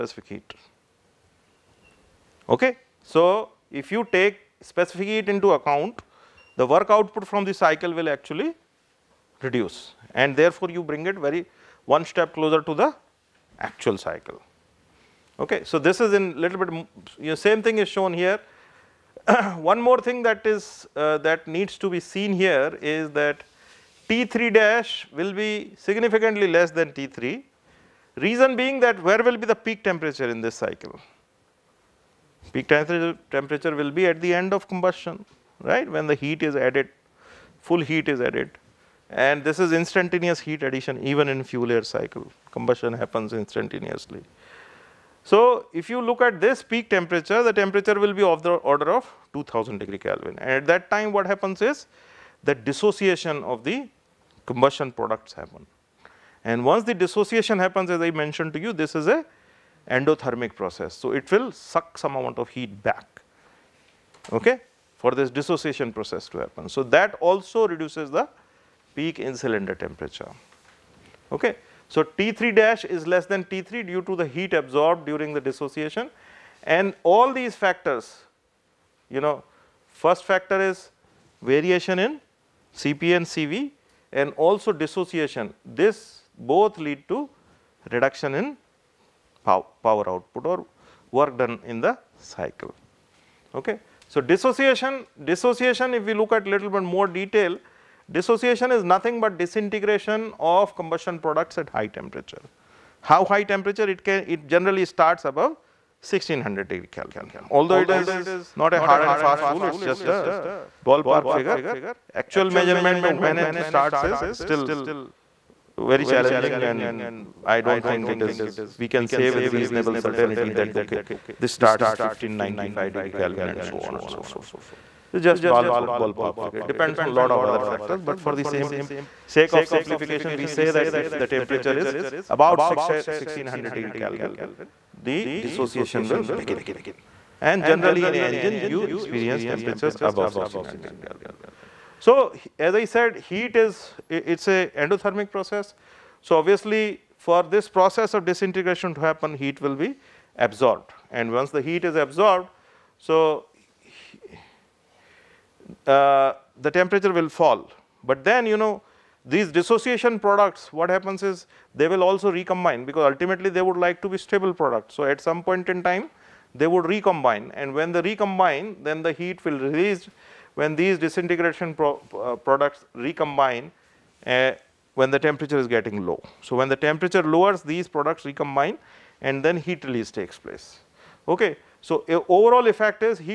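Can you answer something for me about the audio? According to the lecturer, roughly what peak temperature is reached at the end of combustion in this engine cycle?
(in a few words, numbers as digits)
2000 K.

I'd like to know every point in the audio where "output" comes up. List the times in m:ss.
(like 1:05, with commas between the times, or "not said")
0:06, 1:30.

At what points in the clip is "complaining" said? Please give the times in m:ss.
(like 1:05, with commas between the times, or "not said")
not said.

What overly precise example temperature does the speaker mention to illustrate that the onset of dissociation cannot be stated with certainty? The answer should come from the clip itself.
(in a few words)
1595 K.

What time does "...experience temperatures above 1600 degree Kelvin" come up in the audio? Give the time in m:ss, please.
2:18.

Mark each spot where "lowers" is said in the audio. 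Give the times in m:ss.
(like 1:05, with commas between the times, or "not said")
2:57.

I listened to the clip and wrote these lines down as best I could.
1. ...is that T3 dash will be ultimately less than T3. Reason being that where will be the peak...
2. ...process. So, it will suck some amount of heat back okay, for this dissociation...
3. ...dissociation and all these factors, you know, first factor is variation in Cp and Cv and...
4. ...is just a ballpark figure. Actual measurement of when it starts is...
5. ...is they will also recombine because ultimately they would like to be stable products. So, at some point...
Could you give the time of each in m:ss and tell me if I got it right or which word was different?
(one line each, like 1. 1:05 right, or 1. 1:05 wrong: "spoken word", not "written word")
1. 0:22 wrong: "significantly", not "ultimately"
2. 1:00 right
3. 1:15 right
4. 1:49 right
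5. 2:41 right.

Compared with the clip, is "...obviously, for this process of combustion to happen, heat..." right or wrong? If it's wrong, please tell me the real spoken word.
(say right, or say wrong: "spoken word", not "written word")
wrong: "disintegration", not "combustion".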